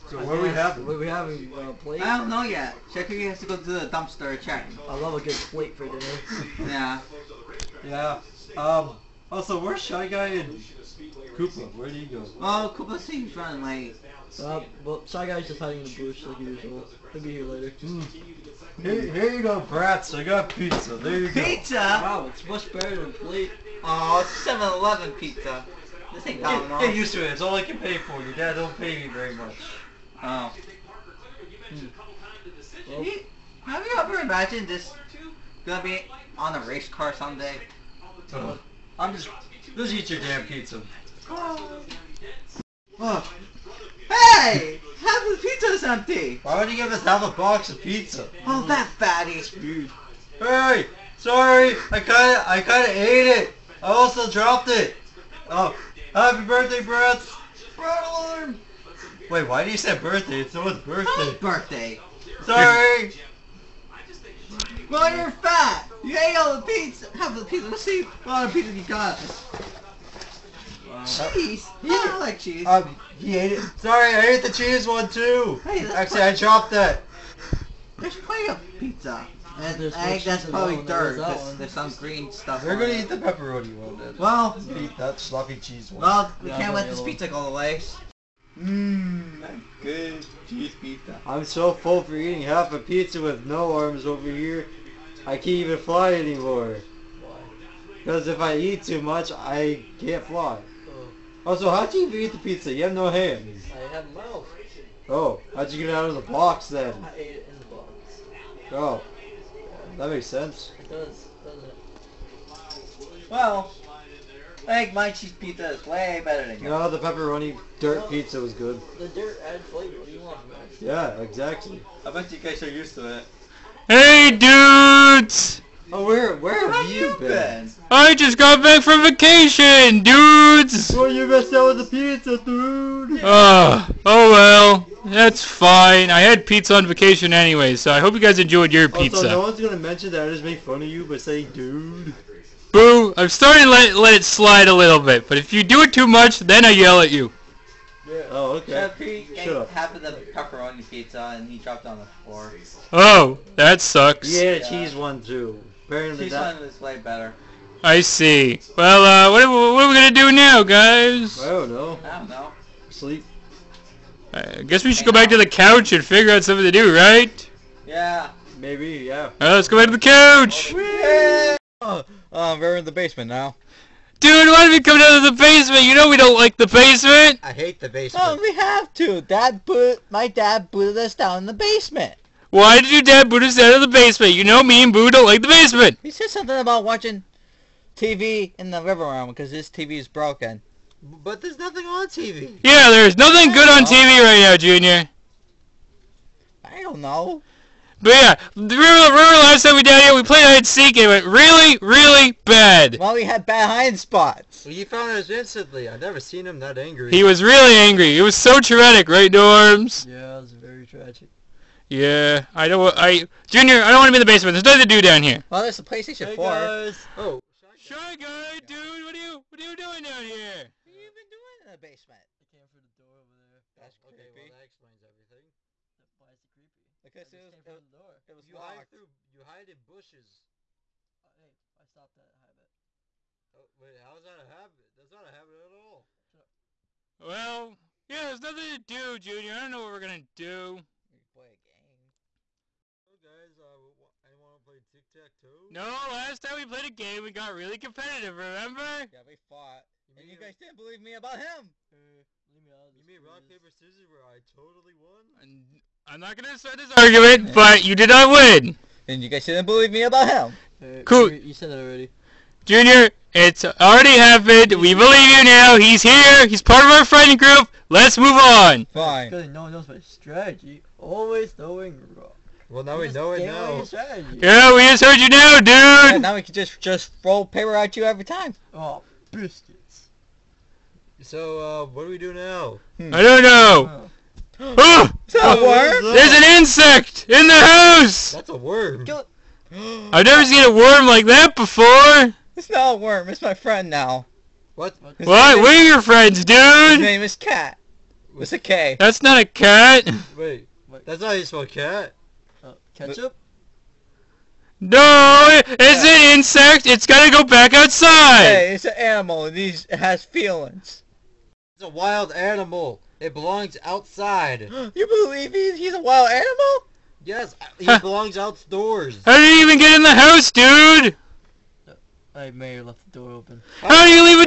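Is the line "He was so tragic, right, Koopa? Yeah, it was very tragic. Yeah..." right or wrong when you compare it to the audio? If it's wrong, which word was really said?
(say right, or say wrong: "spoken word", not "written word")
wrong: "Norms", not "Koopa".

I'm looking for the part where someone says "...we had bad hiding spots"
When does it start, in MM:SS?
03:23.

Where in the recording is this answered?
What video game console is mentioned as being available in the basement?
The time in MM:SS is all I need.
03:35.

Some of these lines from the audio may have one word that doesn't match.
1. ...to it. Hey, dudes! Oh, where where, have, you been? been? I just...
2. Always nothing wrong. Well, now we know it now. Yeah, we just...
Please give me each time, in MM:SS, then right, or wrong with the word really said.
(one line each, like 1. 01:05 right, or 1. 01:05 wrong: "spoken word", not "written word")
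1. 02:02 right
2. 04:30 wrong: "knowing", not "nothing".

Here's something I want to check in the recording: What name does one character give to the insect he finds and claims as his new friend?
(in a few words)
Kat.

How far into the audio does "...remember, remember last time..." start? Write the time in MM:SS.
03:18.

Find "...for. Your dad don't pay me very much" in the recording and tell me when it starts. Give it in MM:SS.
00:27.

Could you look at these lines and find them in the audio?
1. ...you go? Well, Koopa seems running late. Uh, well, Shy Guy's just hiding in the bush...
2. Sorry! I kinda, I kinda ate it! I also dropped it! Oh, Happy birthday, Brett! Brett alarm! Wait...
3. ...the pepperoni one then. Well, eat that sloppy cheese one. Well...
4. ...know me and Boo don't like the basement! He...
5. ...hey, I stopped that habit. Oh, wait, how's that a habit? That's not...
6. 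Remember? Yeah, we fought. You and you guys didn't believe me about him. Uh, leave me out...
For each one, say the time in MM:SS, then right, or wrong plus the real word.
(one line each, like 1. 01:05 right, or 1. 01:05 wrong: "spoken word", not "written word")
1. 00:11 right
2. 00:51 right
3. 01:23 right
4. 03:04 right
5. 03:51 right
6. 04:08 right.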